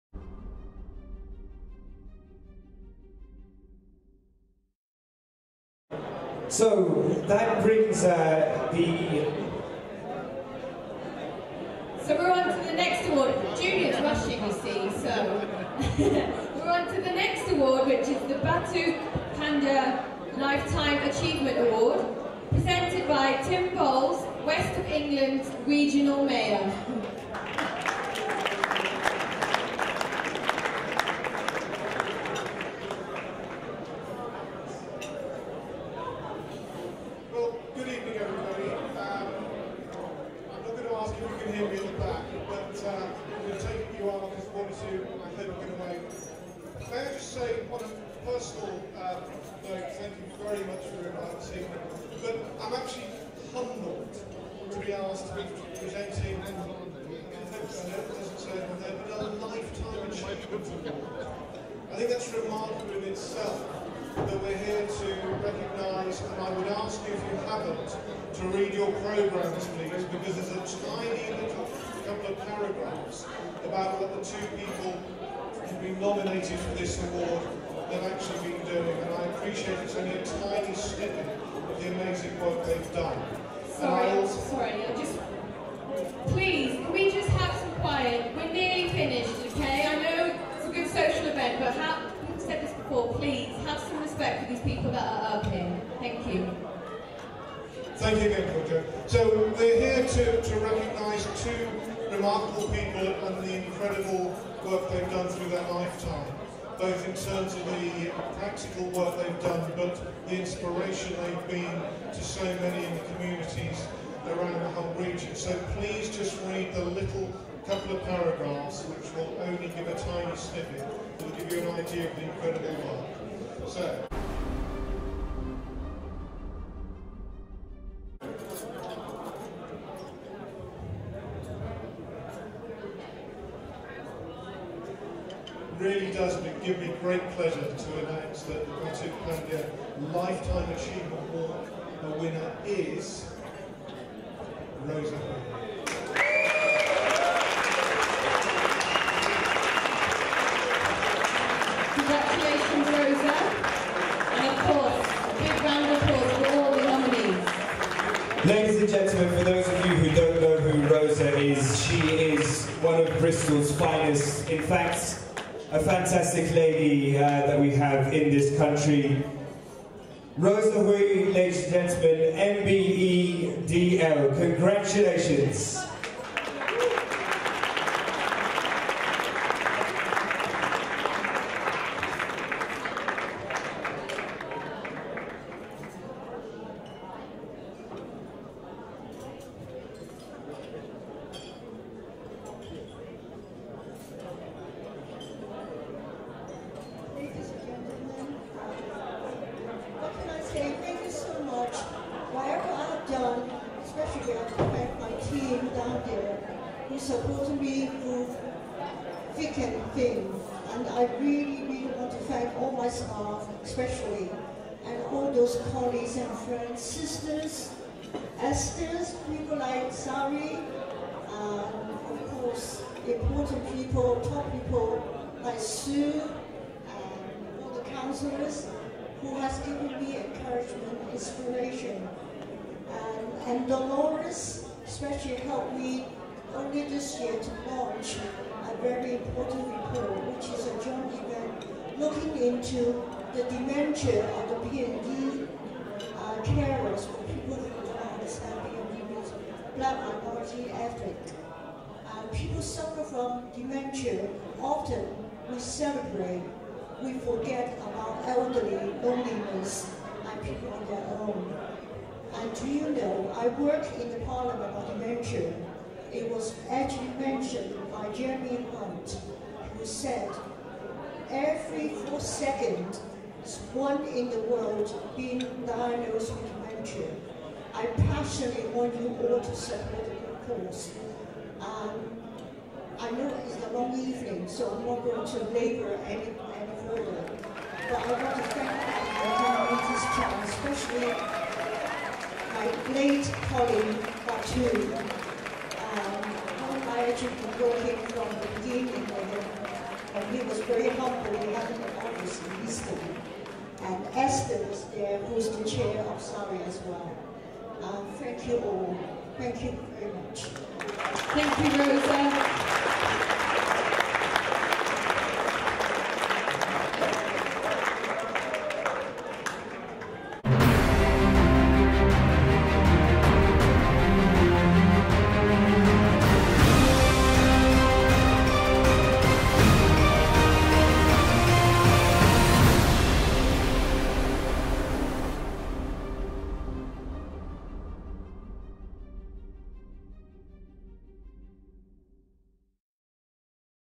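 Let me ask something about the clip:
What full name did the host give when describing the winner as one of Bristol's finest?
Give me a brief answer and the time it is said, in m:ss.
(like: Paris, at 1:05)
Rosa Hui, at 2:50.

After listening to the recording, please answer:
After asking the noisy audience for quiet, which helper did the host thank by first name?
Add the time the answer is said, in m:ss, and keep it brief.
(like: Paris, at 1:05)
Georgia, at 1:38.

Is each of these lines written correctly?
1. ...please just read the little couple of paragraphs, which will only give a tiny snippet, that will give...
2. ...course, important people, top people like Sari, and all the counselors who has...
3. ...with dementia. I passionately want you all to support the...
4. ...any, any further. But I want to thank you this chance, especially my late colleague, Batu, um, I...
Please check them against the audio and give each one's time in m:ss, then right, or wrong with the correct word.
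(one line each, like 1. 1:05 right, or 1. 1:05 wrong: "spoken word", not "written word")
1. 1:55 right
2. 3:42 wrong: "Sue", not "Sari"
3. 4:36 right
4. 4:46 right.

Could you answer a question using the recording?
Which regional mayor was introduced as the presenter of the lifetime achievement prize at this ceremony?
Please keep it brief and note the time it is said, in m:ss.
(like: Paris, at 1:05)
Tim Bowles, at 0:23.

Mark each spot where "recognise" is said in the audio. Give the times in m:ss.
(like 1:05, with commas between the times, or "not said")
1:05, 1:40.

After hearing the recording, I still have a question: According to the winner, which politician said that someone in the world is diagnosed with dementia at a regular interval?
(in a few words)
Jeremy Hunt.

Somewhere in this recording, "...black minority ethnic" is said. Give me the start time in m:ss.
4:09.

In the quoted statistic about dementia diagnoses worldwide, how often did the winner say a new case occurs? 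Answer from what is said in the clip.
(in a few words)
every 4 seconds.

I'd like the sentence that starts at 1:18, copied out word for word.
And I appreciate it's only a tiny snippet of the amazing work they've done.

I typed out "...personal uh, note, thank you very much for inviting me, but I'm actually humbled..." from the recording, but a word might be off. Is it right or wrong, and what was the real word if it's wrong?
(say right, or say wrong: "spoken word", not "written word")
right.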